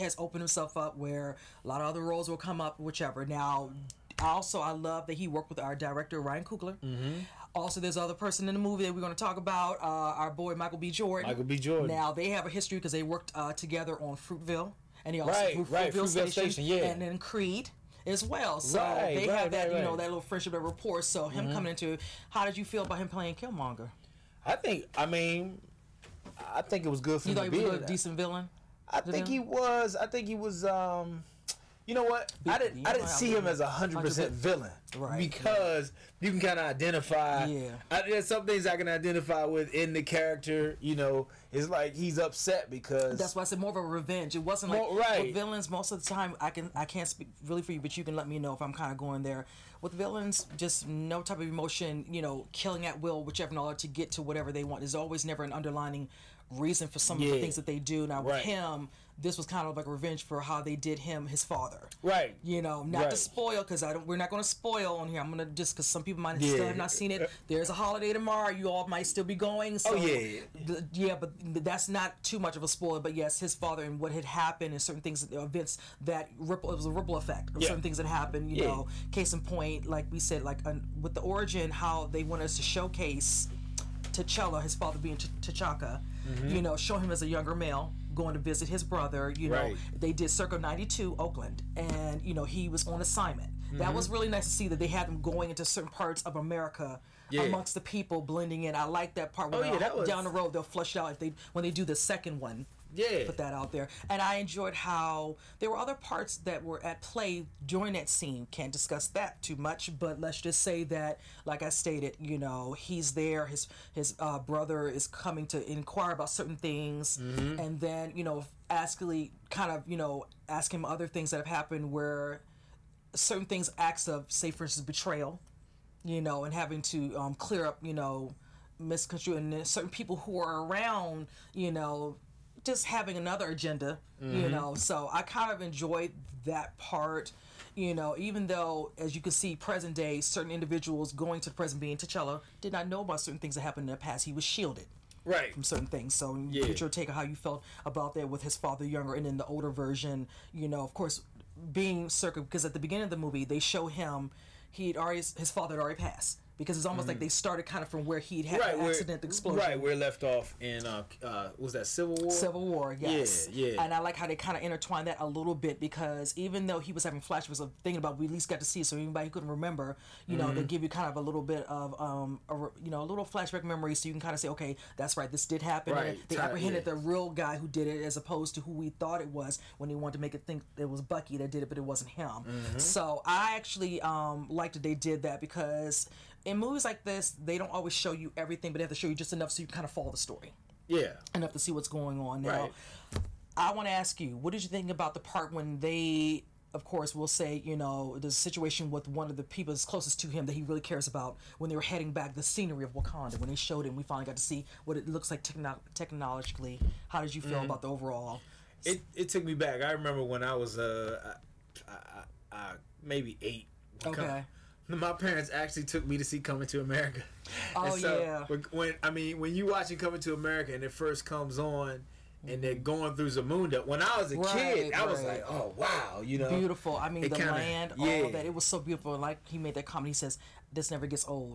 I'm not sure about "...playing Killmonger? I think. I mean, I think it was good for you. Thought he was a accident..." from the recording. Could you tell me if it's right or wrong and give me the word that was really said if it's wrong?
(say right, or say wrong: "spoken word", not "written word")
wrong: "decent", not "accident".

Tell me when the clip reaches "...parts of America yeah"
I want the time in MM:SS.
01:35.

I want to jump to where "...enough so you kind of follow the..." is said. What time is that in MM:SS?
03:09.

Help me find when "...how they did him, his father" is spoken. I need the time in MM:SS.
01:00.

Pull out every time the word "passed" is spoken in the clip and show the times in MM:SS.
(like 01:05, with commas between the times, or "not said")
02:36.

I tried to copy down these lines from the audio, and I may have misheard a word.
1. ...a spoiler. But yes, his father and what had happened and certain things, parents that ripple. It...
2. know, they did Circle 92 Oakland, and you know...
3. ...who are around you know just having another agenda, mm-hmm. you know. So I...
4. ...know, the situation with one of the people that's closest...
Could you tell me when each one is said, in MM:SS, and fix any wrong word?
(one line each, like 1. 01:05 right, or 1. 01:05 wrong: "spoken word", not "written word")
1. 01:12 wrong: "events", not "parents"
2. 01:29 right
3. 02:10 right
4. 03:17 right.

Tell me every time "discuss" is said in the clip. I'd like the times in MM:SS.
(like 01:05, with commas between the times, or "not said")
01:48.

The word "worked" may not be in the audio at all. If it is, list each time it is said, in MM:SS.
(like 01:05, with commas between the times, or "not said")
00:05, 00:13.